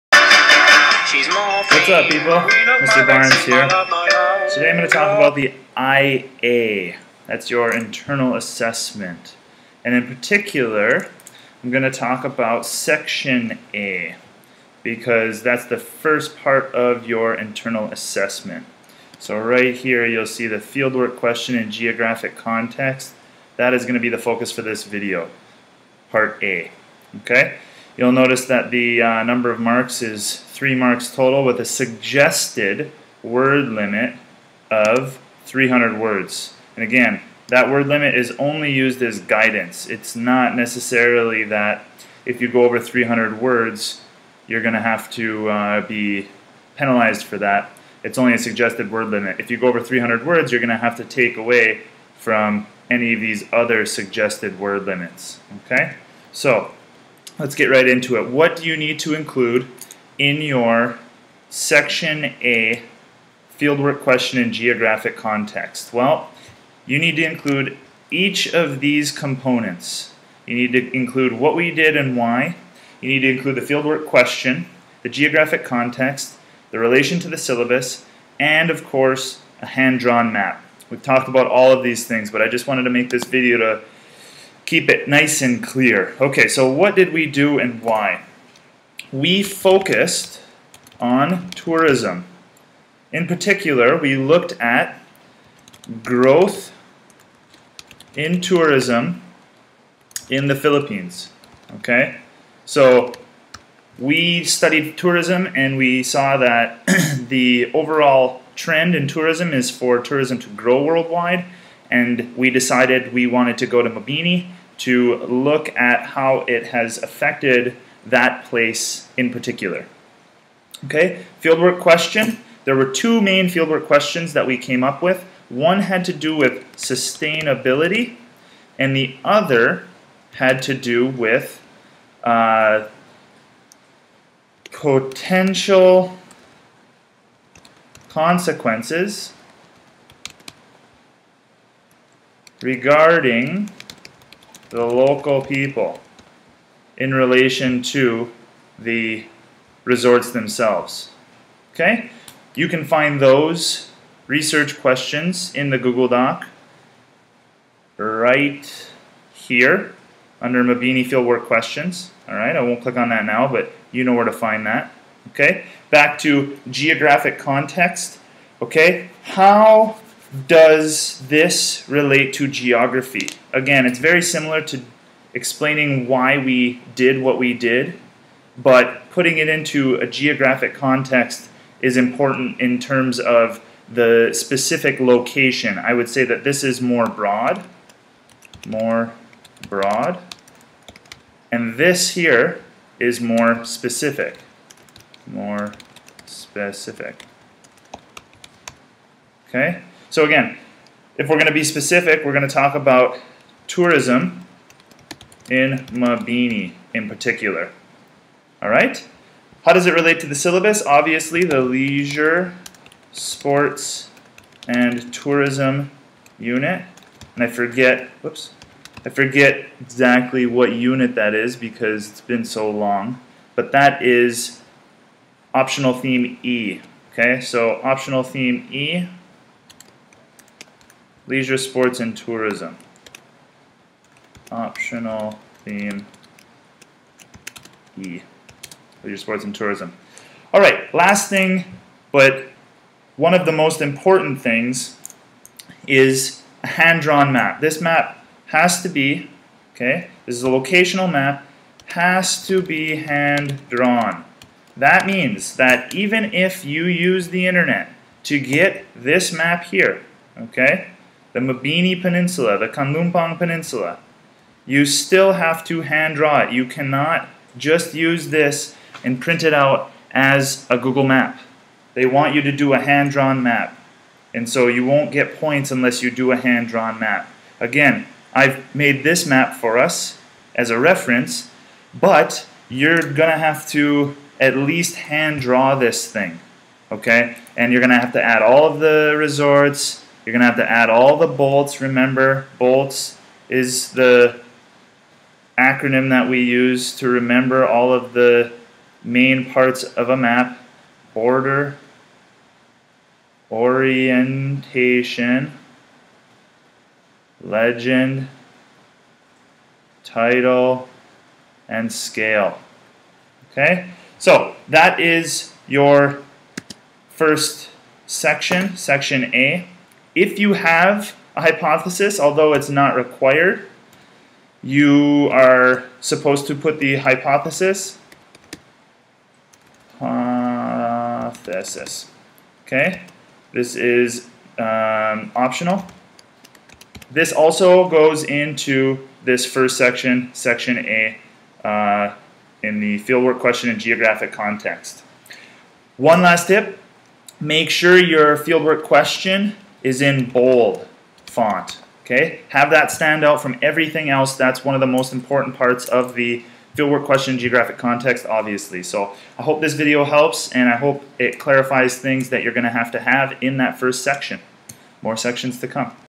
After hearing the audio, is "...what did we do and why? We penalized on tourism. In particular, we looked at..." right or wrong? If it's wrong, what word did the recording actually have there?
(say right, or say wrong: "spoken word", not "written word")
wrong: "focused", not "penalized".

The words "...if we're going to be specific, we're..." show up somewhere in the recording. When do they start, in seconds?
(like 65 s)
201 s.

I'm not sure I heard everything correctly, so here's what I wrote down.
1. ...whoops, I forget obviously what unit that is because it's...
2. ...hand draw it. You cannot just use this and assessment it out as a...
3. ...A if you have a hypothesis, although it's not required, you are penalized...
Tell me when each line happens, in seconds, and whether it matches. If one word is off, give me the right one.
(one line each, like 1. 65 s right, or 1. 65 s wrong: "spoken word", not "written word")
1. 218 s wrong: "exactly", not "obviously"
2. 265 s wrong: "print", not "assessment"
3. 319 s wrong: "supposed", not "penalized".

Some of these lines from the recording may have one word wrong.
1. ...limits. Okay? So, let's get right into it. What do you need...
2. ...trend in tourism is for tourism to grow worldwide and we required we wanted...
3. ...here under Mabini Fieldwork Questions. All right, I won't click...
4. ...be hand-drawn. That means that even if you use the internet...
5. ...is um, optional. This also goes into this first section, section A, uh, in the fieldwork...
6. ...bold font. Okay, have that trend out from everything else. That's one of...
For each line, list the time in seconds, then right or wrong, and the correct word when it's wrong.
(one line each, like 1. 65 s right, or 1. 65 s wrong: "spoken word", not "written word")
1. 54 s right
2. 108 s wrong: "decided", not "required"
3. 159 s right
4. 252 s right
5. 333 s right
6. 350 s wrong: "stand", not "trend".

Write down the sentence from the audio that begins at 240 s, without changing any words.
All right, last thing, but one of the most important things is a hand-drawn map.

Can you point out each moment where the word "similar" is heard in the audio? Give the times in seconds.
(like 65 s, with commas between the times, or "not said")
174 s.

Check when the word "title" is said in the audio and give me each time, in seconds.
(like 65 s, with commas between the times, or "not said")
310 s.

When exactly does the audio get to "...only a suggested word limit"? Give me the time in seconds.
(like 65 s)
48 s.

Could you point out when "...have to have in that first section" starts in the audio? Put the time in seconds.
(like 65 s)
362 s.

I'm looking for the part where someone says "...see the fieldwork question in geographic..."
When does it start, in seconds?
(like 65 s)
20 s.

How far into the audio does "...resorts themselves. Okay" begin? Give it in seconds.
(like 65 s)
149 s.